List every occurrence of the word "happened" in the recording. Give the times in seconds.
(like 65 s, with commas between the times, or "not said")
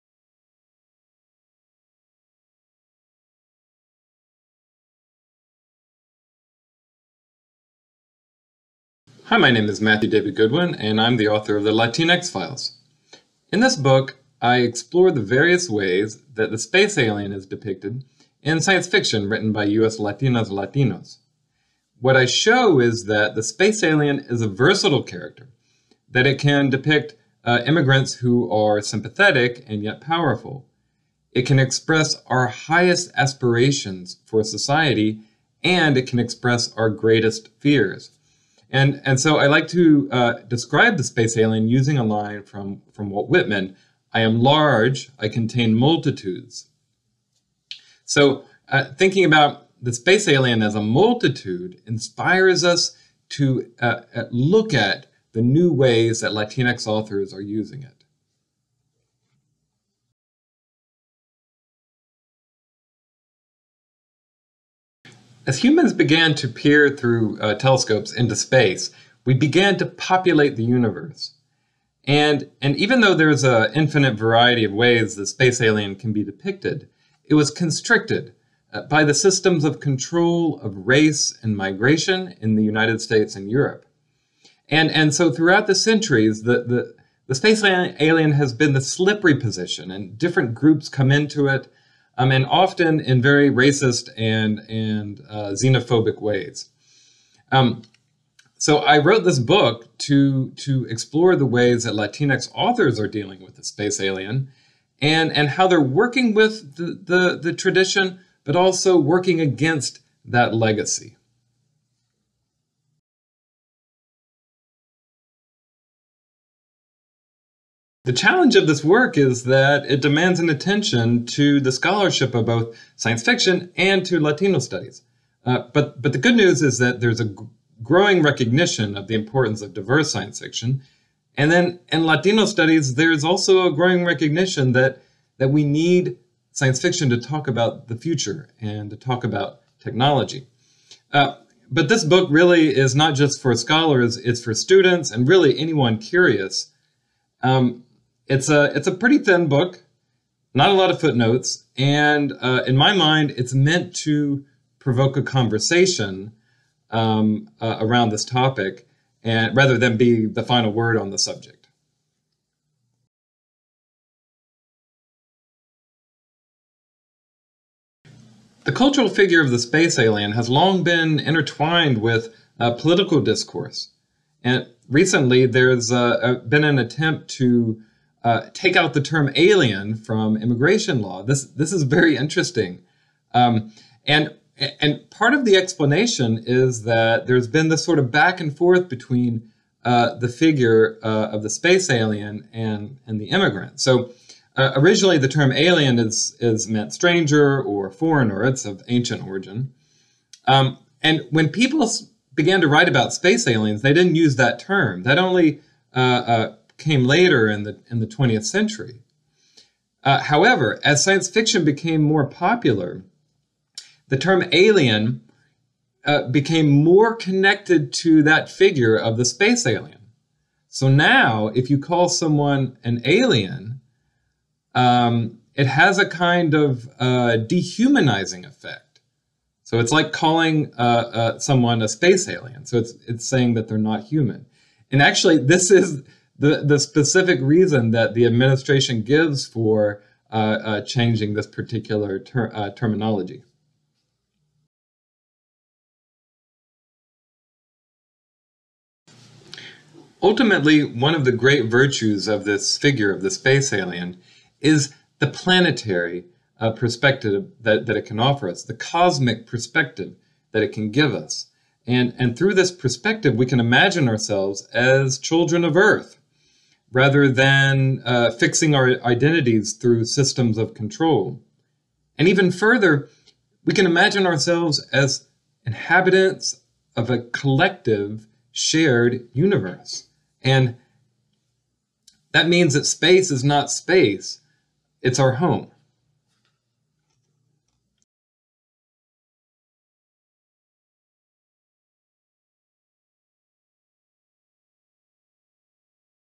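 not said.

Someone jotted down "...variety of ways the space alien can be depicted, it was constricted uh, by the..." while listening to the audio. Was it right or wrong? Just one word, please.
right.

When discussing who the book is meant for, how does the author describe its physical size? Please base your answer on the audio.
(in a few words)
pretty thin.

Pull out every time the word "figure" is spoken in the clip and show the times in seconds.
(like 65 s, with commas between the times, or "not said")
169 s, 190 s, 218 s, 252 s.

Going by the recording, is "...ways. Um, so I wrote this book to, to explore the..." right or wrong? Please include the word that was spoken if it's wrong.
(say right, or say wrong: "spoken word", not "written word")
right.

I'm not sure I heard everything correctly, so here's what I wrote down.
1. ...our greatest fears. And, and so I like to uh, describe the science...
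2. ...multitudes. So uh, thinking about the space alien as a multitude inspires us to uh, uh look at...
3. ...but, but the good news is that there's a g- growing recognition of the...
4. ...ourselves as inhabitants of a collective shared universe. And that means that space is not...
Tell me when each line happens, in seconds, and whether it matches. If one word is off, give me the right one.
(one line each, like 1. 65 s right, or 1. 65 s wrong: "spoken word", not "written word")
1. 36 s wrong: "space", not "science"
2. 45 s right
3. 125 s right
4. 274 s right.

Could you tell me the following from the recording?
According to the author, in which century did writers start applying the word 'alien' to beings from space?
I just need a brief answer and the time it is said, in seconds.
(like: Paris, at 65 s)
20th century, at 208 s.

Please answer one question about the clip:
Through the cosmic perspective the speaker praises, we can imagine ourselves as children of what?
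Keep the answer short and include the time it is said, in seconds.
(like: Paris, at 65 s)
Earth, at 265 s.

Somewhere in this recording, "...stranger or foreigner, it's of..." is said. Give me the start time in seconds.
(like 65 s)
196 s.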